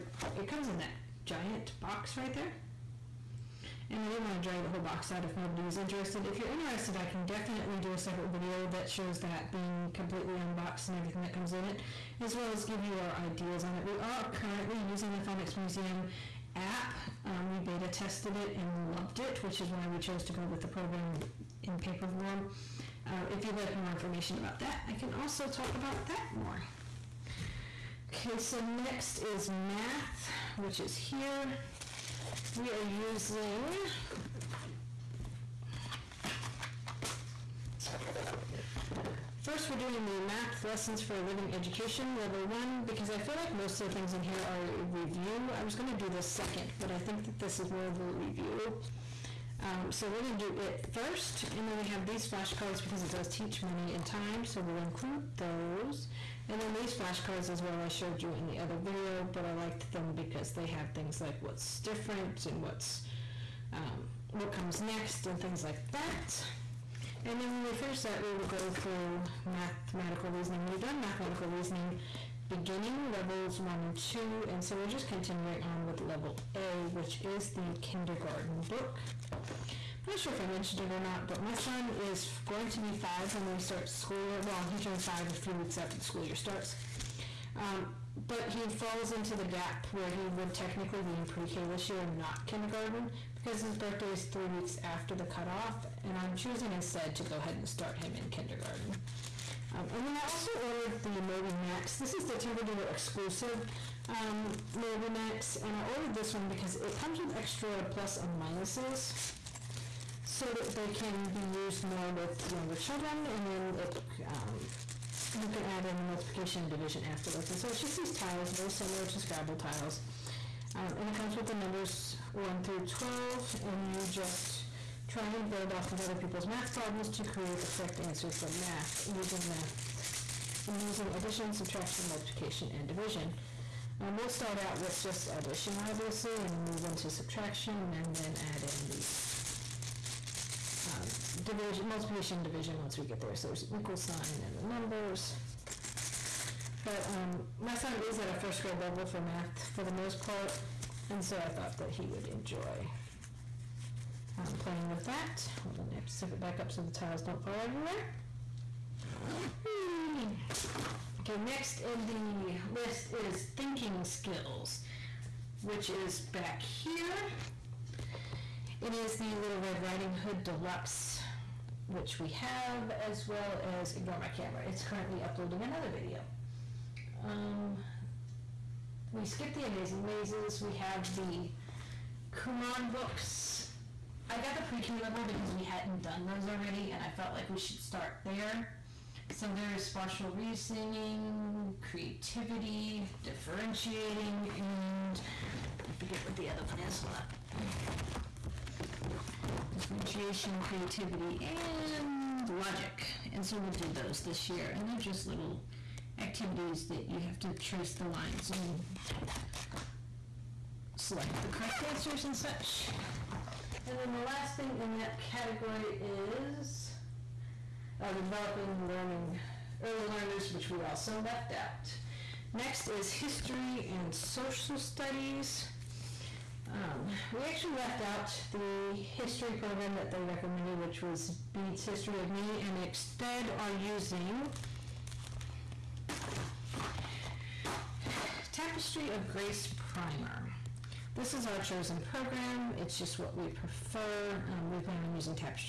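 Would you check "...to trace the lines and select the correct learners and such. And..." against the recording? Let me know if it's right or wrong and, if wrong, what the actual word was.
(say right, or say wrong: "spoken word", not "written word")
wrong: "answers", not "learners".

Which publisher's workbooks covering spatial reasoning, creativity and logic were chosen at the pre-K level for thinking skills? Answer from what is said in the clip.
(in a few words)
Kumon.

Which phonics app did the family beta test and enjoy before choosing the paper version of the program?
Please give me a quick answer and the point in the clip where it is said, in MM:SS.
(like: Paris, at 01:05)
Phonics Museum, at 00:15.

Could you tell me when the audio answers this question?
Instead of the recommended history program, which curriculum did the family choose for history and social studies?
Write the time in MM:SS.
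03:58.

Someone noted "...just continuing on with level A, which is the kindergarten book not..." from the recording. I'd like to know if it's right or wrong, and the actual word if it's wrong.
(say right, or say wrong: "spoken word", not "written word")
right.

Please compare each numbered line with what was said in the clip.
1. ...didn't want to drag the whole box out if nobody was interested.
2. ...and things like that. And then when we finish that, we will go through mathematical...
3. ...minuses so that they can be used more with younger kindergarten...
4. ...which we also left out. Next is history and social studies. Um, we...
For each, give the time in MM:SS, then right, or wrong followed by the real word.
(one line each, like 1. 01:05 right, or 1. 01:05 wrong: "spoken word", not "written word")
1. 00:04 right
2. 01:05 right
3. 01:48 wrong: "children", not "kindergarten"
4. 03:40 right.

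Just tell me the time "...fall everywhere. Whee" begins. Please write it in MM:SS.
02:37.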